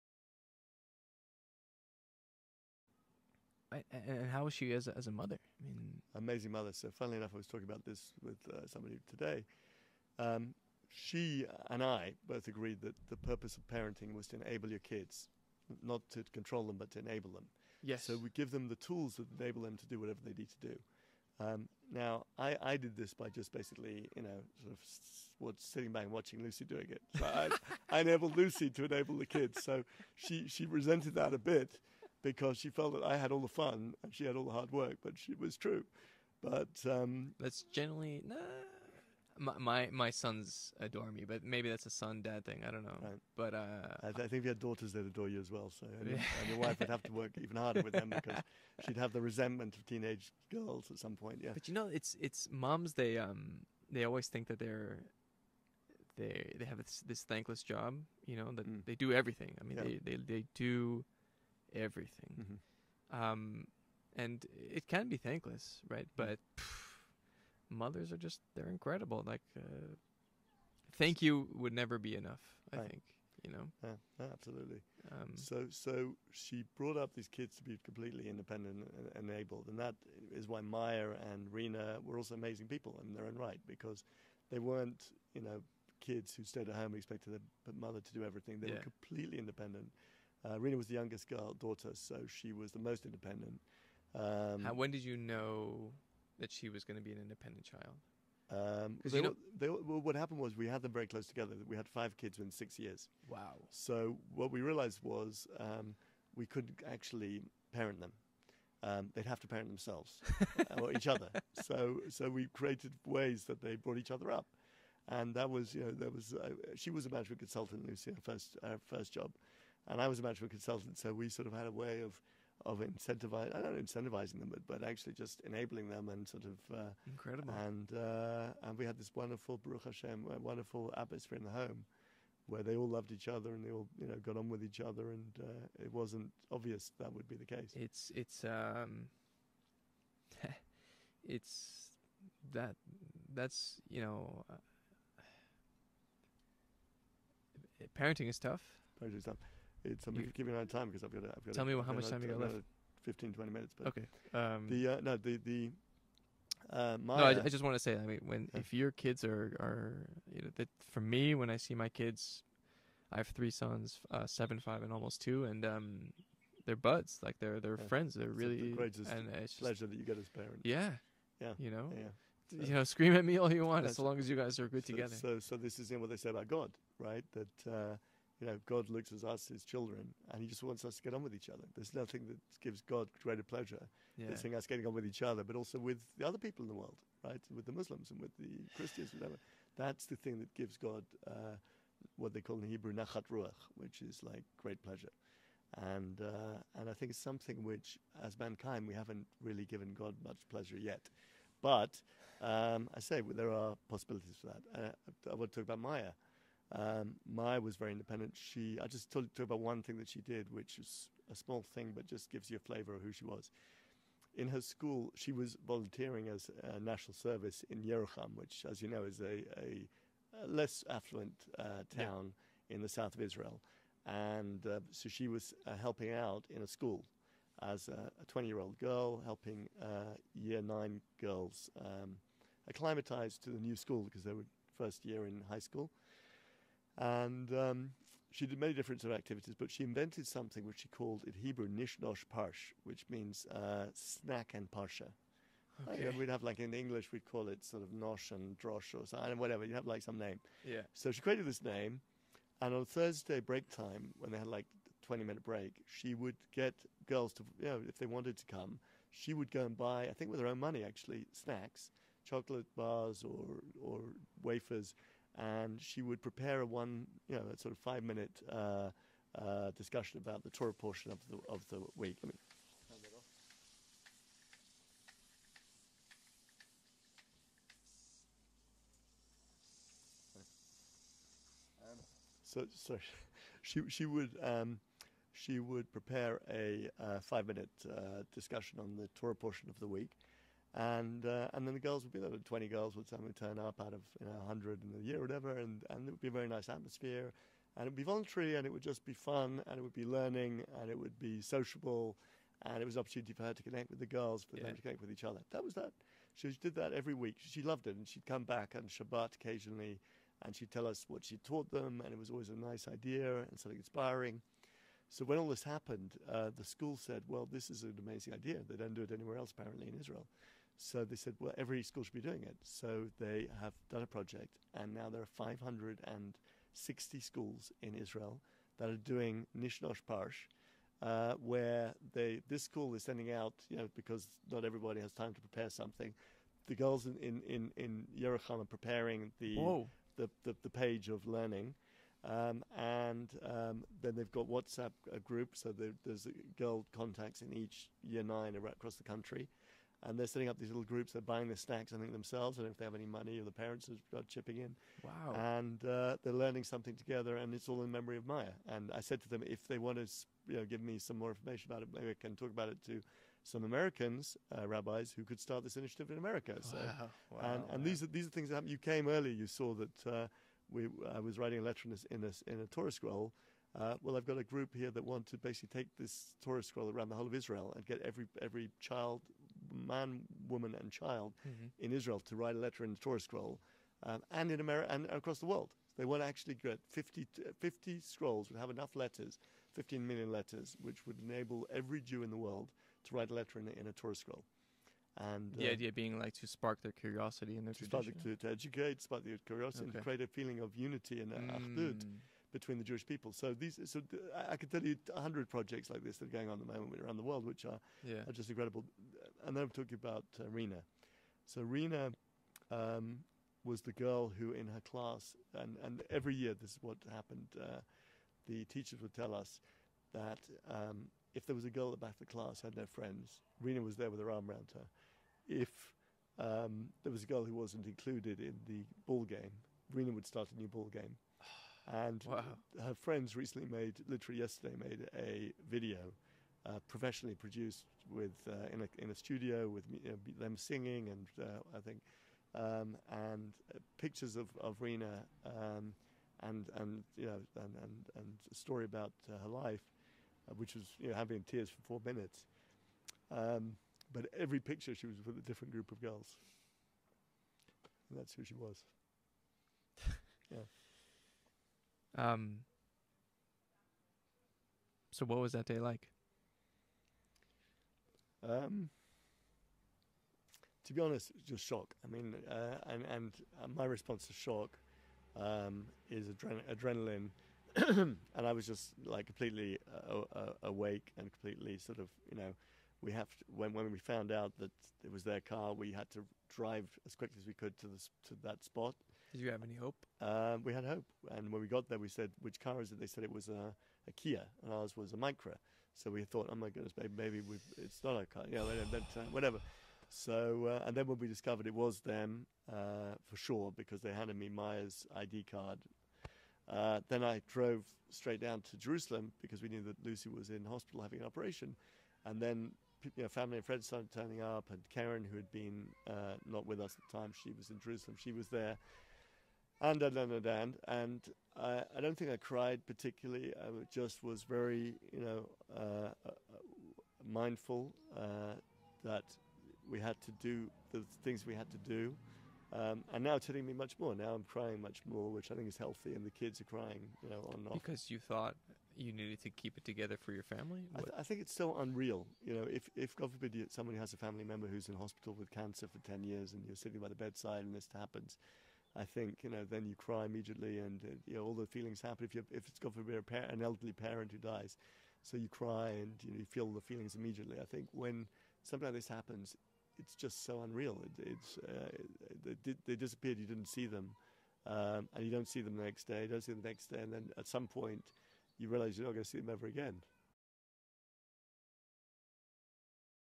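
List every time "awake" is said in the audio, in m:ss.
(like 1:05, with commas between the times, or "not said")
8:00.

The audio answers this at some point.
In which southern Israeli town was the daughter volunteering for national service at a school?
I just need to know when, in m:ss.
3:37.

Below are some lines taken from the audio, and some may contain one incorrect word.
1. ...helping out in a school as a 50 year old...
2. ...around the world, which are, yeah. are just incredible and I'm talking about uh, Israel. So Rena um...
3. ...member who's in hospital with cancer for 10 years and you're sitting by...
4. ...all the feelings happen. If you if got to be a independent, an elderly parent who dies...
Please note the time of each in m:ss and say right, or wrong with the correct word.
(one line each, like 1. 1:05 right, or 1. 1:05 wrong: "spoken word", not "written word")
1. 3:45 wrong: "20", not "50"
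2. 6:47 wrong: "Rena", not "Israel"
3. 9:04 right
4. 9:11 wrong: "parent", not "independent".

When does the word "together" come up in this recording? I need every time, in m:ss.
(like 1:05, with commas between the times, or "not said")
1:41, 2:54, 5:56, 8:59.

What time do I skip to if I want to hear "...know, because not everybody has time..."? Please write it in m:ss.
5:33.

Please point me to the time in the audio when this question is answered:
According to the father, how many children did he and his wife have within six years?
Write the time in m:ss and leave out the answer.
1:41.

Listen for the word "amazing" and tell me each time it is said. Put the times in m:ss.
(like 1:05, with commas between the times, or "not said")
0:06, 1:22, 5:17.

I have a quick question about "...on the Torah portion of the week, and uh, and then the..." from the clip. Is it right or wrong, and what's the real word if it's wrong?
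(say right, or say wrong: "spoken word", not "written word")
right.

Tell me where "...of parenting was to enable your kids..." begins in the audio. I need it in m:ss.
0:13.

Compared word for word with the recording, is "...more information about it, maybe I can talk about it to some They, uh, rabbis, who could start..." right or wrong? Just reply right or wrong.
wrong.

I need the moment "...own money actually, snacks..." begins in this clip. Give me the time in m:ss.
4:20.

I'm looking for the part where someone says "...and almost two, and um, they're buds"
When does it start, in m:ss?
2:44.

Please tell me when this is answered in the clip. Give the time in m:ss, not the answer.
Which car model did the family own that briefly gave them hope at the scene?
8:15.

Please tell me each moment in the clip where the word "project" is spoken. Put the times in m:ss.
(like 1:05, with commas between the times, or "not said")
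5:24, 6:45.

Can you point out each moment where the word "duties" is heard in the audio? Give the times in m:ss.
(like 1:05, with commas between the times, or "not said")
not said.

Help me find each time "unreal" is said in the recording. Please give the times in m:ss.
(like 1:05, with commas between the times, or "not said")
9:01, 9:20.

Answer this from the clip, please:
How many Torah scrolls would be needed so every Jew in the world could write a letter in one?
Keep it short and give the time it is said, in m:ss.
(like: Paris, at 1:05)
50, at 6:27.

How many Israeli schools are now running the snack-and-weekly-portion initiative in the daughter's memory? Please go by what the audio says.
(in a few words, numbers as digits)
560.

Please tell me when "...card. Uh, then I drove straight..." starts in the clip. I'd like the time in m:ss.
8:25.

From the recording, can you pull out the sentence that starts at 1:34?
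Um, How, when did you know that she was going to be an independent child?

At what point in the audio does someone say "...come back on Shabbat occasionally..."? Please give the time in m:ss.
5:08.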